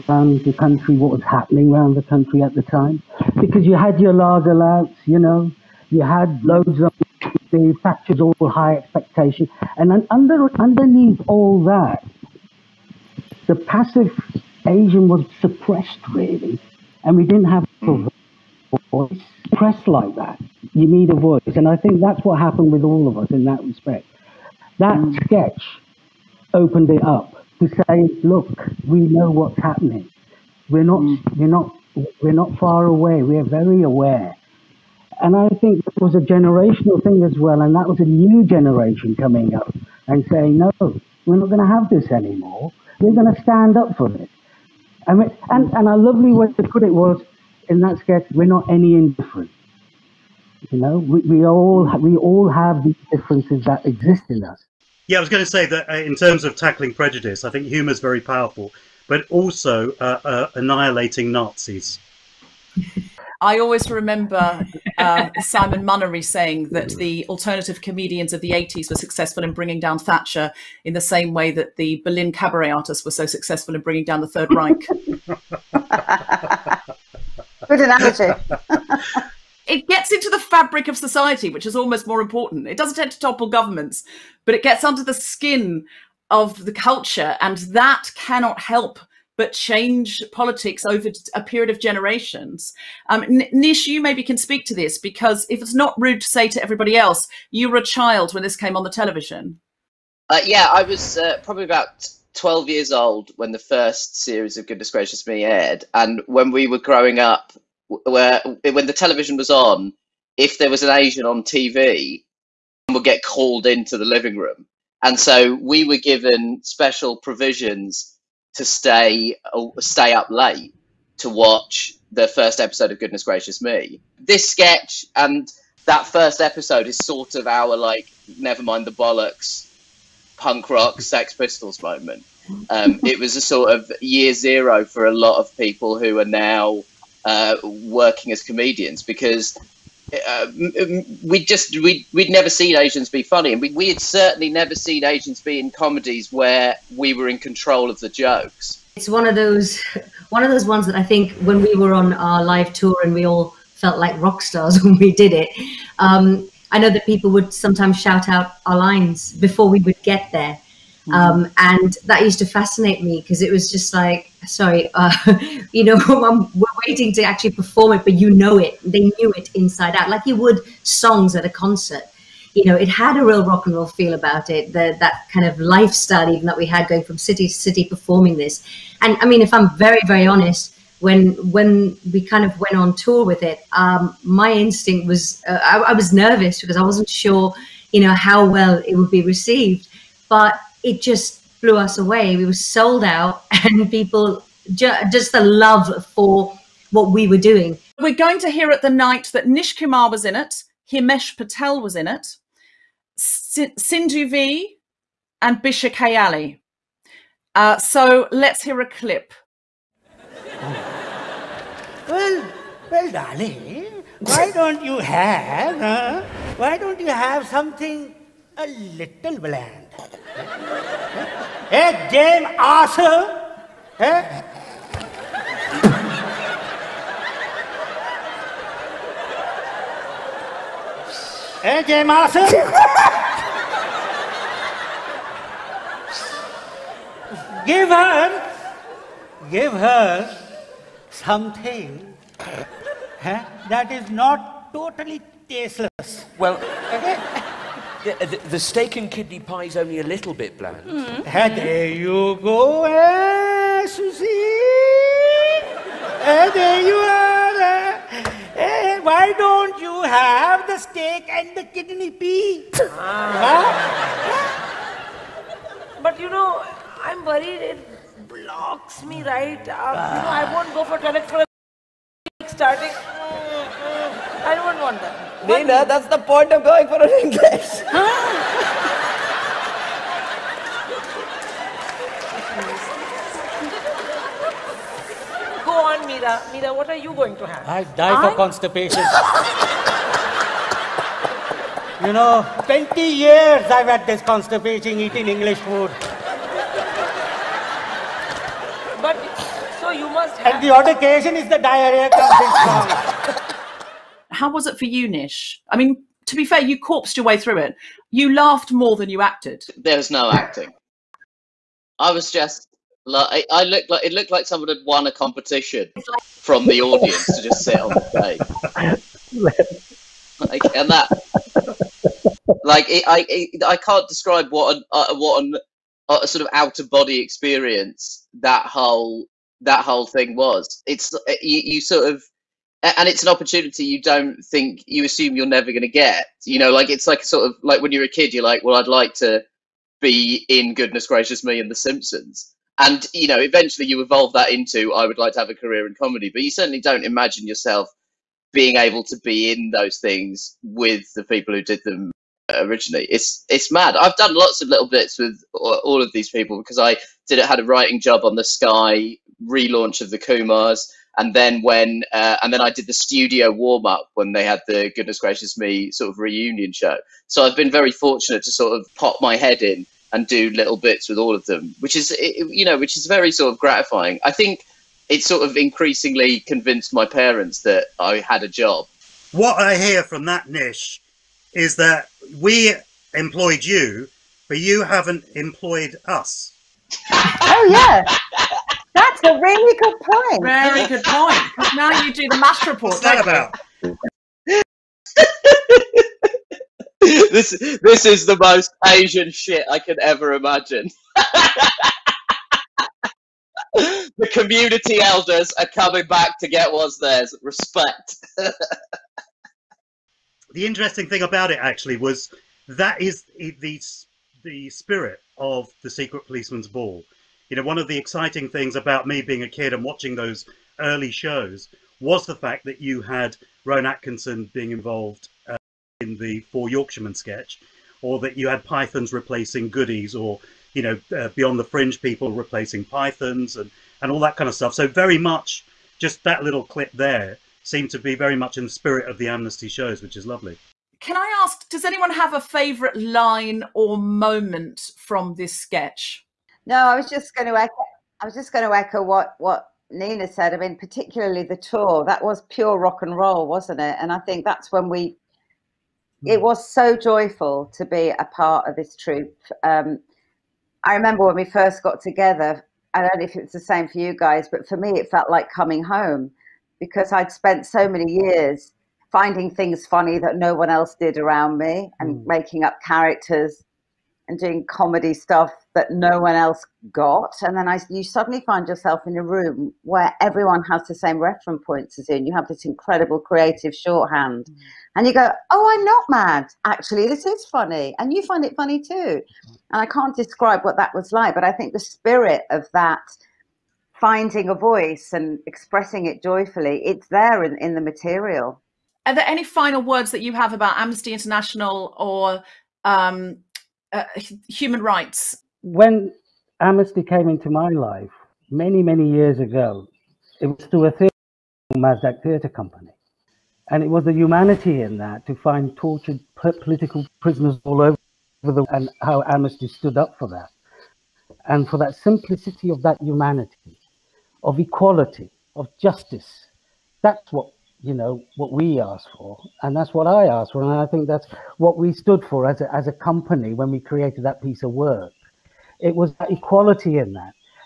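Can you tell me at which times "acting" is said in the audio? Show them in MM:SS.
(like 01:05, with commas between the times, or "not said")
05:10.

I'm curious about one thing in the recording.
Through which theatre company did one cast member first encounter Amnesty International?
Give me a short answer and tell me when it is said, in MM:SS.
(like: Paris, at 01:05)
Mazdak Theatre Company, at 08:31.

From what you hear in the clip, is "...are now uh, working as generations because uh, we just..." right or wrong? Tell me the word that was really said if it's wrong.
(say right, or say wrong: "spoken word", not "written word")
wrong: "comedians", not "generations".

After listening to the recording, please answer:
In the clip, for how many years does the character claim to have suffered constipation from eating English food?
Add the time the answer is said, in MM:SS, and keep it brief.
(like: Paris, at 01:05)
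20, at 04:52.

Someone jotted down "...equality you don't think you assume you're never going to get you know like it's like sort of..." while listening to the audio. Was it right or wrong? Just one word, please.
wrong.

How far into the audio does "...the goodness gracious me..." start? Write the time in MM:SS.
06:04.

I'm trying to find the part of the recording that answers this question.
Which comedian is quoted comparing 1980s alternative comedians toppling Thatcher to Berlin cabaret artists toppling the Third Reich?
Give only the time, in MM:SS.
01:05.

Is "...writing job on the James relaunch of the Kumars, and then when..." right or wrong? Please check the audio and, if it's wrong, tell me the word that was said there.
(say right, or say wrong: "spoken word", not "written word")
wrong: "Sky", not "James".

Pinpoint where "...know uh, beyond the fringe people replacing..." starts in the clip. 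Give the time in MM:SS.
07:10.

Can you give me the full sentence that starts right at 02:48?
They knew it inside out, like you would songs at a concert.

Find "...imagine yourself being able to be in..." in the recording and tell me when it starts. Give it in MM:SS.
05:47.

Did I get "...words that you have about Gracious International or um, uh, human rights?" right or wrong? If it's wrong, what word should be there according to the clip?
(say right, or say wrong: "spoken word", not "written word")
wrong: "Amnesty", not "Gracious".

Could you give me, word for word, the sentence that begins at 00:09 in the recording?
And under, underneath all that, the passive Asian was suppressed really.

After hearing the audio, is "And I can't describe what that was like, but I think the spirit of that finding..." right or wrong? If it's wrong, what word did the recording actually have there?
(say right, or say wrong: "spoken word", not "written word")
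right.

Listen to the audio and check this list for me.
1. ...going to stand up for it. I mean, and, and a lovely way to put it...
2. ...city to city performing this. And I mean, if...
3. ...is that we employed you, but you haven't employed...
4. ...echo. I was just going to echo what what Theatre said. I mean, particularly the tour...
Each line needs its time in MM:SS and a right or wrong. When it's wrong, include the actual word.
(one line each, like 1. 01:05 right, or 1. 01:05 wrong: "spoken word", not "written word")
1. 00:43 right
2. 02:57 right
3. 06:21 right
4. 07:27 wrong: "Nina", not "Theatre".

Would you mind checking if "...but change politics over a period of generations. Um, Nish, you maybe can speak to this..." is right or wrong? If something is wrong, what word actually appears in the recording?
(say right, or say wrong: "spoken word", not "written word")
right.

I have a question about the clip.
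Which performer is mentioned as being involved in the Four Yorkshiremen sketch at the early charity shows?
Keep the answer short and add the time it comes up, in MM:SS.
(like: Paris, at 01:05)
Rowan Atkinson, at 07:03.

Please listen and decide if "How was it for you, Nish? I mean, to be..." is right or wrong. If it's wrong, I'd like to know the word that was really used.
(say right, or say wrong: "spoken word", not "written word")
right.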